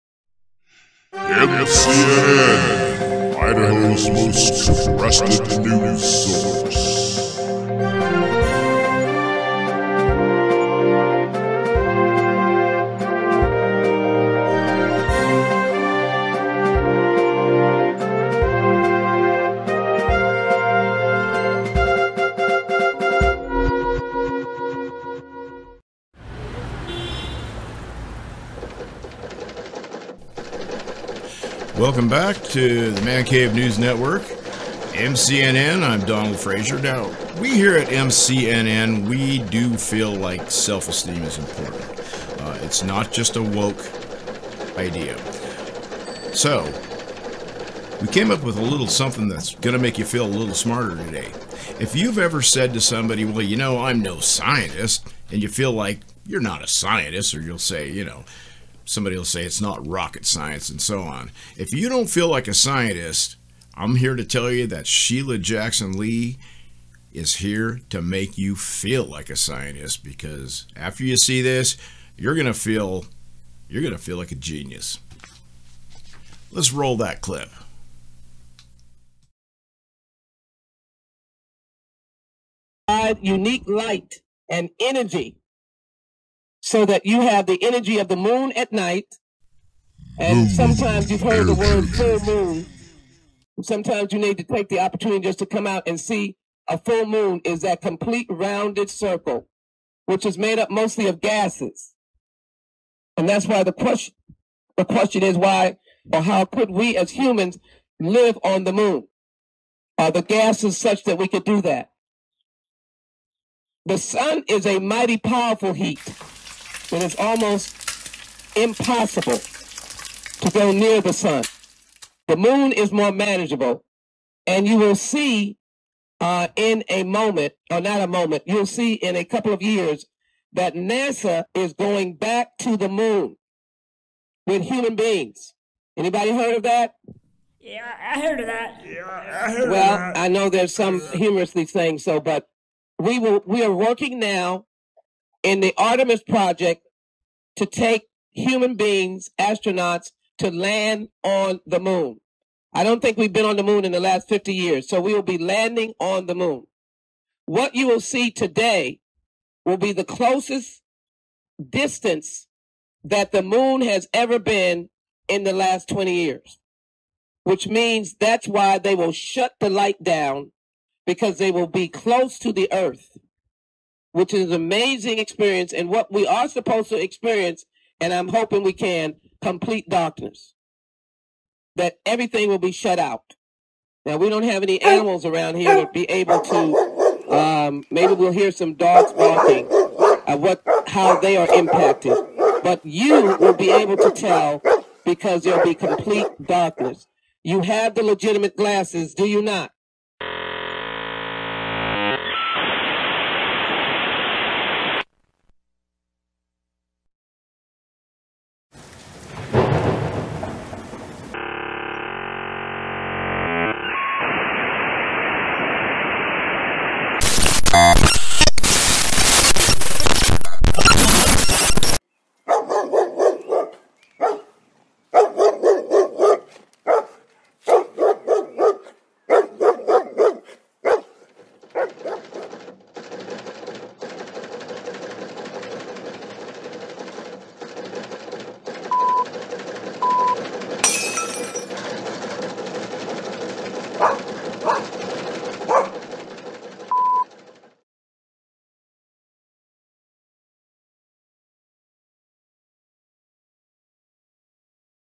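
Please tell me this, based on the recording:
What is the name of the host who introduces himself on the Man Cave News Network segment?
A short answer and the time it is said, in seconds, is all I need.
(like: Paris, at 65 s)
Donald Fraser, at 36 s.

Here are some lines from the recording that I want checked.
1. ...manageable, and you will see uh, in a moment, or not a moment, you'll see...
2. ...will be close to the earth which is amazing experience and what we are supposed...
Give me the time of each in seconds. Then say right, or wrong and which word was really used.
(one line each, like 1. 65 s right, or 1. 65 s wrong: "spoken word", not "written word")
1. 123 s right
2. 171 s right.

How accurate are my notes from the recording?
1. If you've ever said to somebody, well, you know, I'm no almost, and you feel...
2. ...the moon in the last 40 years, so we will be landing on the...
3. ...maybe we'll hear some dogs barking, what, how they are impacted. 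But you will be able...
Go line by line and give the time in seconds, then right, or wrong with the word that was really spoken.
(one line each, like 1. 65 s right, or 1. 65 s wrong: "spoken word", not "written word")
1. 51 s wrong: "scientist", not "almost"
2. 153 s wrong: "50", not "40"
3. 187 s right.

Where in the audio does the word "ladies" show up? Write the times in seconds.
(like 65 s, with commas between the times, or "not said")
not said.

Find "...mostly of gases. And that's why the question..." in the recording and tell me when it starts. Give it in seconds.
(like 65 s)
100 s.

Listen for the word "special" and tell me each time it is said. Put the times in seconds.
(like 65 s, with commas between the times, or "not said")
not said.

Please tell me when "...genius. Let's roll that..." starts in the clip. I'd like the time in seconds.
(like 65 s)
74 s.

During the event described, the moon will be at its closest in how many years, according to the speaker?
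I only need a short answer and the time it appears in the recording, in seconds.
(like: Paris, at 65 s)
20, at 165 s.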